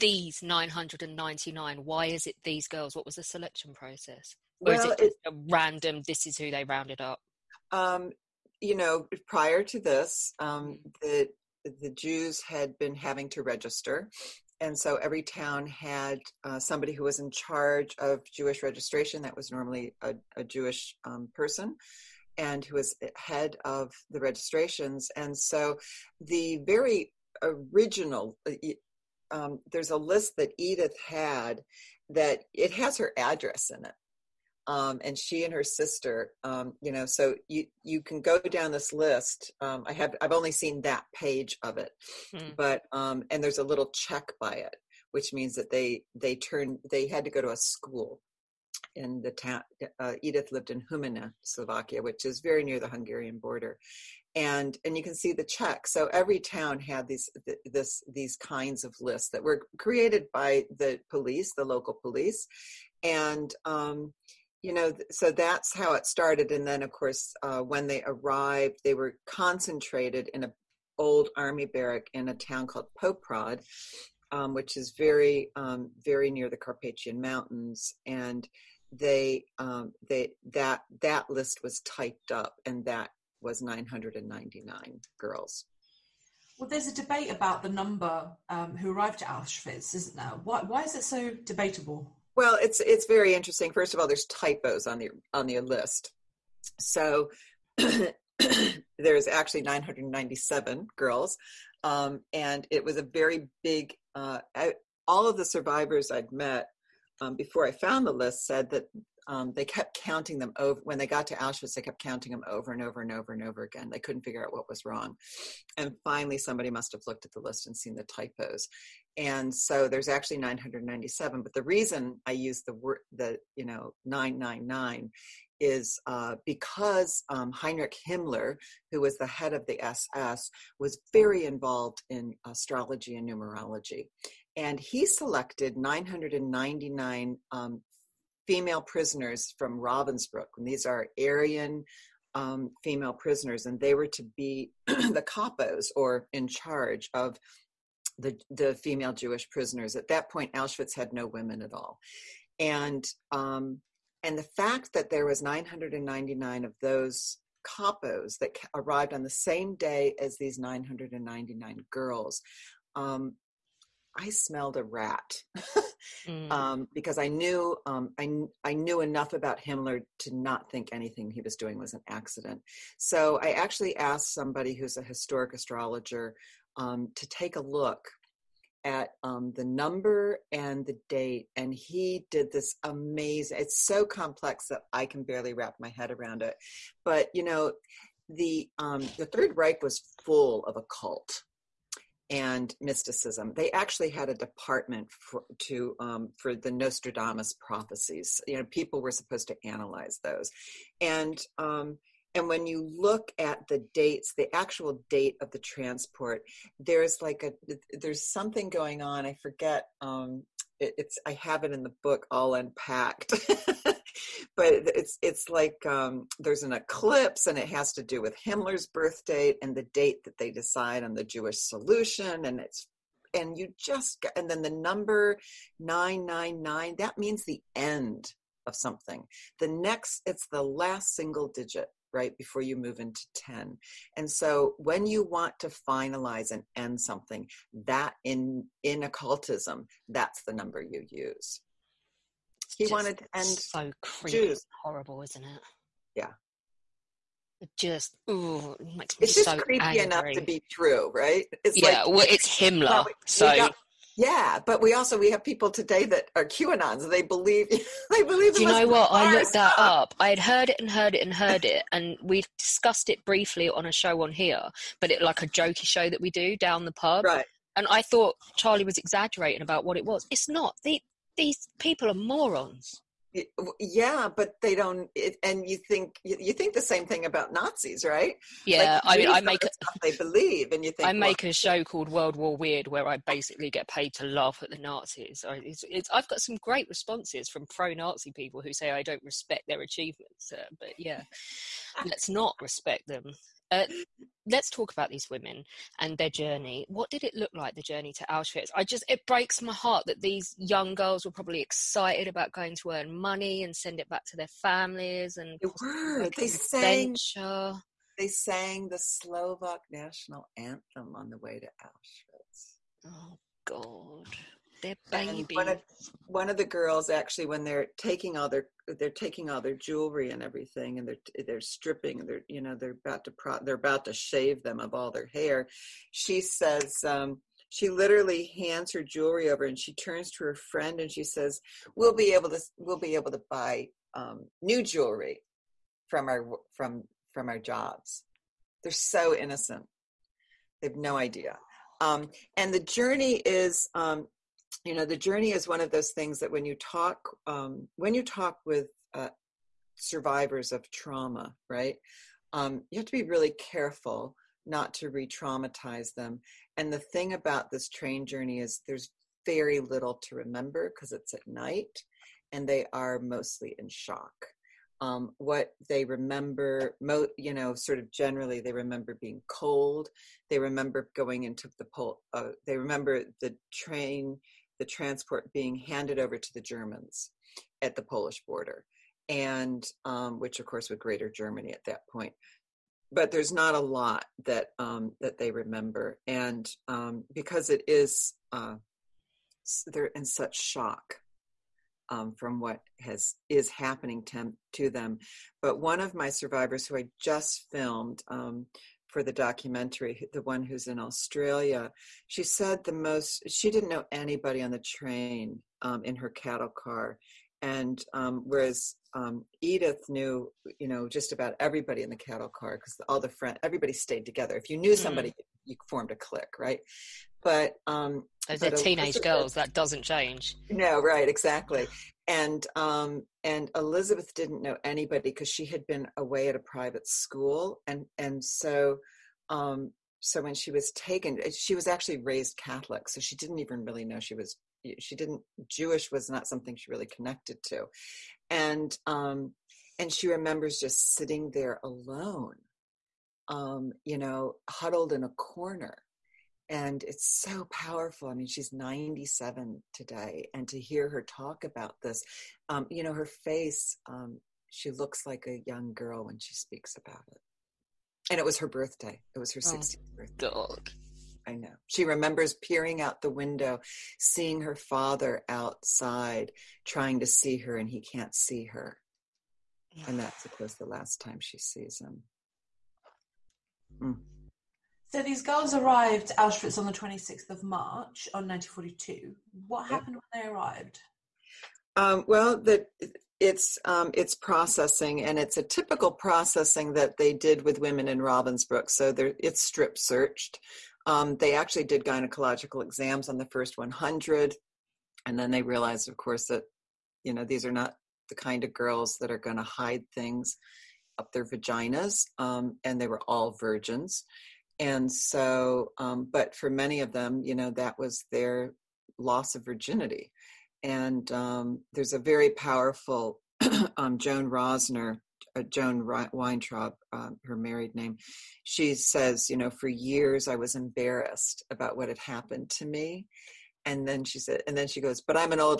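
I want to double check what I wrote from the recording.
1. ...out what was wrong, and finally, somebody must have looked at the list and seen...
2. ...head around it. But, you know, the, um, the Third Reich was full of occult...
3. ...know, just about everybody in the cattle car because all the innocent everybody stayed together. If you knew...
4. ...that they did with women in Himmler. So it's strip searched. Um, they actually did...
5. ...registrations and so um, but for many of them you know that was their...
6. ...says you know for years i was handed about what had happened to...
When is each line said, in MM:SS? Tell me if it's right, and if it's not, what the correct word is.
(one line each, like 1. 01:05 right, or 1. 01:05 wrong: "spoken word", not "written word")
1. 01:54 right
2. 03:05 right
3. 06:50 wrong: "front", not "innocent"
4. 08:06 wrong: "Ravensbrück", not "Himmler"
5. 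08:23 wrong: "virgins", not "registrations"
6. 08:38 wrong: "embarrassed", not "handed".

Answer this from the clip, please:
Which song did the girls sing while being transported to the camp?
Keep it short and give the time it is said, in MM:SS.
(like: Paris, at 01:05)
Slovak national anthem, at 05:08.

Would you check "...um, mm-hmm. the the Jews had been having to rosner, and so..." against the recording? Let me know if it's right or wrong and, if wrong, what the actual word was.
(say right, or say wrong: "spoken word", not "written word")
wrong: "register", not "rosner".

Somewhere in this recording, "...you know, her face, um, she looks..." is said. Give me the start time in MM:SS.
07:32.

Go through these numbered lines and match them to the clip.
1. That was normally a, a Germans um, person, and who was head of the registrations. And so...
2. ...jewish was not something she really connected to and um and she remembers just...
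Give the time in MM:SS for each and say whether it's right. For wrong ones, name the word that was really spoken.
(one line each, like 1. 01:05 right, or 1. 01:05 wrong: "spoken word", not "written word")
1. 00:19 wrong: "Jewish", not "Germans"
2. 07:15 right.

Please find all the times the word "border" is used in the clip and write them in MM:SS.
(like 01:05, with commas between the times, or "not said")
00:53, 06:18.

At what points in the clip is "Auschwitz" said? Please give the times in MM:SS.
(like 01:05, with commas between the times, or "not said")
01:29, 01:51, 02:30, 04:58, 05:11, 07:56.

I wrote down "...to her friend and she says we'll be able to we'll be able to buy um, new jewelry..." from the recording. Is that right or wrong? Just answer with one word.
right.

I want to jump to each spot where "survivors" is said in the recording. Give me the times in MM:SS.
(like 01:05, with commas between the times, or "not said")
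01:45, 05:49, 06:36.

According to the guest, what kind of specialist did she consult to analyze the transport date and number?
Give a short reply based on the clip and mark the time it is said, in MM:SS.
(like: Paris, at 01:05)
historic astrologer, at 02:55.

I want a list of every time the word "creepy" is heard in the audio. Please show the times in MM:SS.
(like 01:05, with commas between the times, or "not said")
04:04, 04:09.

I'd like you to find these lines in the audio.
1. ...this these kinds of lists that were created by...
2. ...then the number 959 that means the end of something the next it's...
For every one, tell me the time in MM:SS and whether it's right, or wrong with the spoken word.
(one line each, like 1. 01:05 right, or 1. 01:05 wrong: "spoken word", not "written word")
1. 00:57 right
2. 03:44 wrong: "999", not "959".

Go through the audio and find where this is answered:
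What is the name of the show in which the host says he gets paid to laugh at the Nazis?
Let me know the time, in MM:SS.
04:42.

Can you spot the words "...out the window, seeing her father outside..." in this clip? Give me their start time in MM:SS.
07:42.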